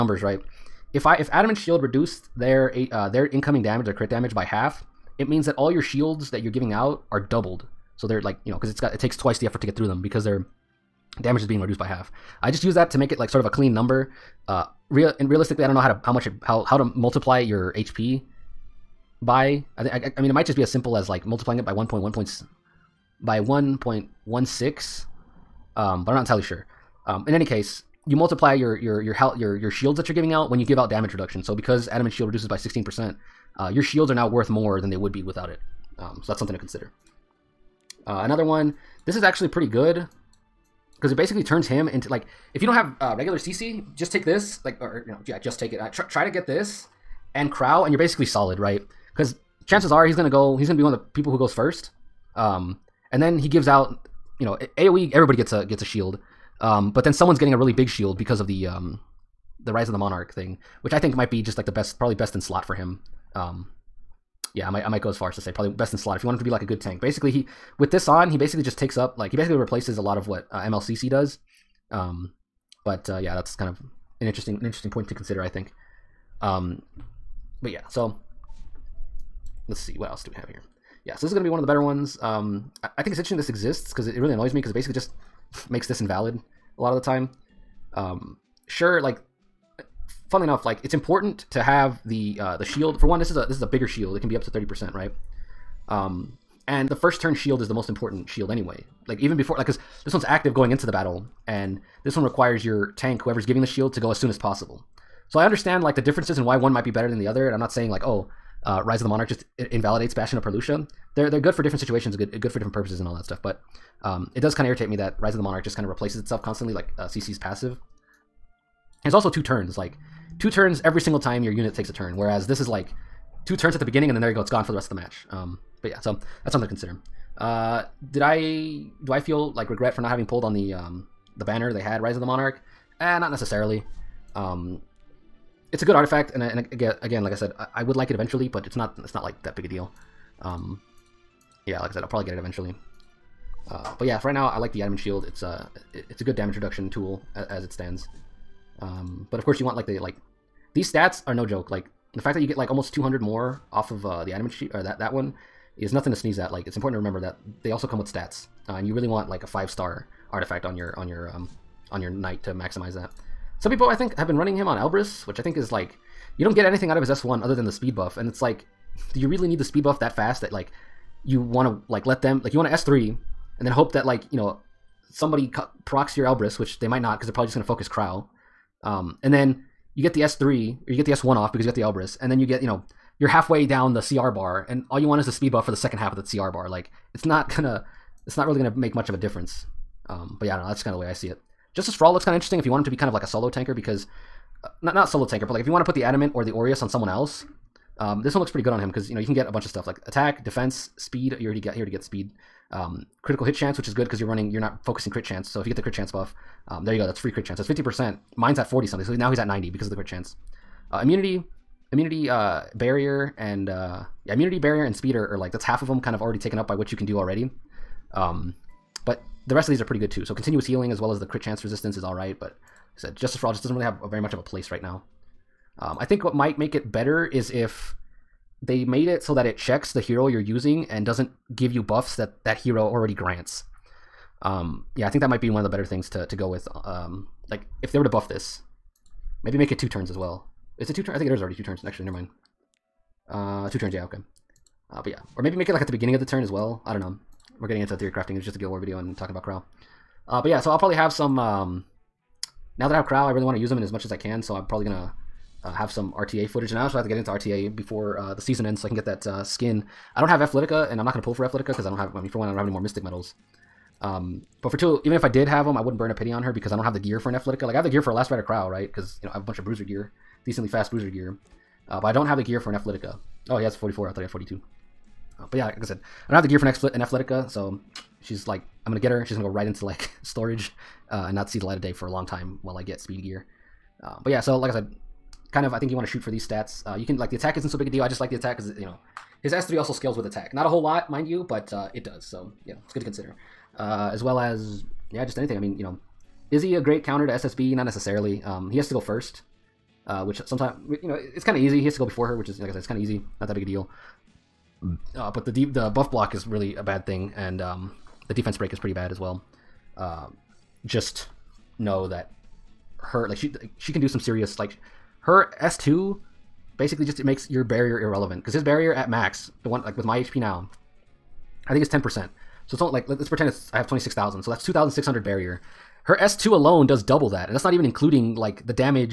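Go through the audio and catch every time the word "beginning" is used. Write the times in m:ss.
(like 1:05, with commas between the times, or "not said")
2:03, 4:05.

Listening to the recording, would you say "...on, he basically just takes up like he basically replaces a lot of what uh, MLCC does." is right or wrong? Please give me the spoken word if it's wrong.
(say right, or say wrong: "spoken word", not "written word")
right.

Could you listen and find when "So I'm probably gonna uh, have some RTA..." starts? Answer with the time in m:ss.
4:14.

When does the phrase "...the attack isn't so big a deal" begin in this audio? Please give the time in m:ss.
4:47.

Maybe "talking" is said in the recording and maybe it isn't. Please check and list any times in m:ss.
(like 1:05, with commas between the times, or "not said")
4:09.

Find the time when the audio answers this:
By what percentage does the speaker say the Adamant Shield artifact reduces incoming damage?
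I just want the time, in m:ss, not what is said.
0:32.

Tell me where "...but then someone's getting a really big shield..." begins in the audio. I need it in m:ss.
0:56.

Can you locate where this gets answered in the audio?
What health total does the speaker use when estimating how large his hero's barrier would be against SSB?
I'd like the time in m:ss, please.
5:23.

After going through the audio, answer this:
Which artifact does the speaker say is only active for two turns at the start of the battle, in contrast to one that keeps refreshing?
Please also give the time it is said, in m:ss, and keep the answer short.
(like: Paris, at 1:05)
Bastion of Perlucia, at 1:50.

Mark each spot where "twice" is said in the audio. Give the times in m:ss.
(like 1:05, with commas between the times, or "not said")
0:09.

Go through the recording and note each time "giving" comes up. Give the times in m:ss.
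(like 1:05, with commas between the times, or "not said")
0:06, 0:30, 1:43.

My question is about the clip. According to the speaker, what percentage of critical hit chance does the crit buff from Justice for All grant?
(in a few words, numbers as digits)
50%.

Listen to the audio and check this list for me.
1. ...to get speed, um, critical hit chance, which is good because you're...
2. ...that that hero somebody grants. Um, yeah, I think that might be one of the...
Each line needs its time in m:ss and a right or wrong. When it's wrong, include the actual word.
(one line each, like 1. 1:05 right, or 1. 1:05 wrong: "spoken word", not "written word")
1. 3:21 right
2. 3:52 wrong: "already", not "somebody".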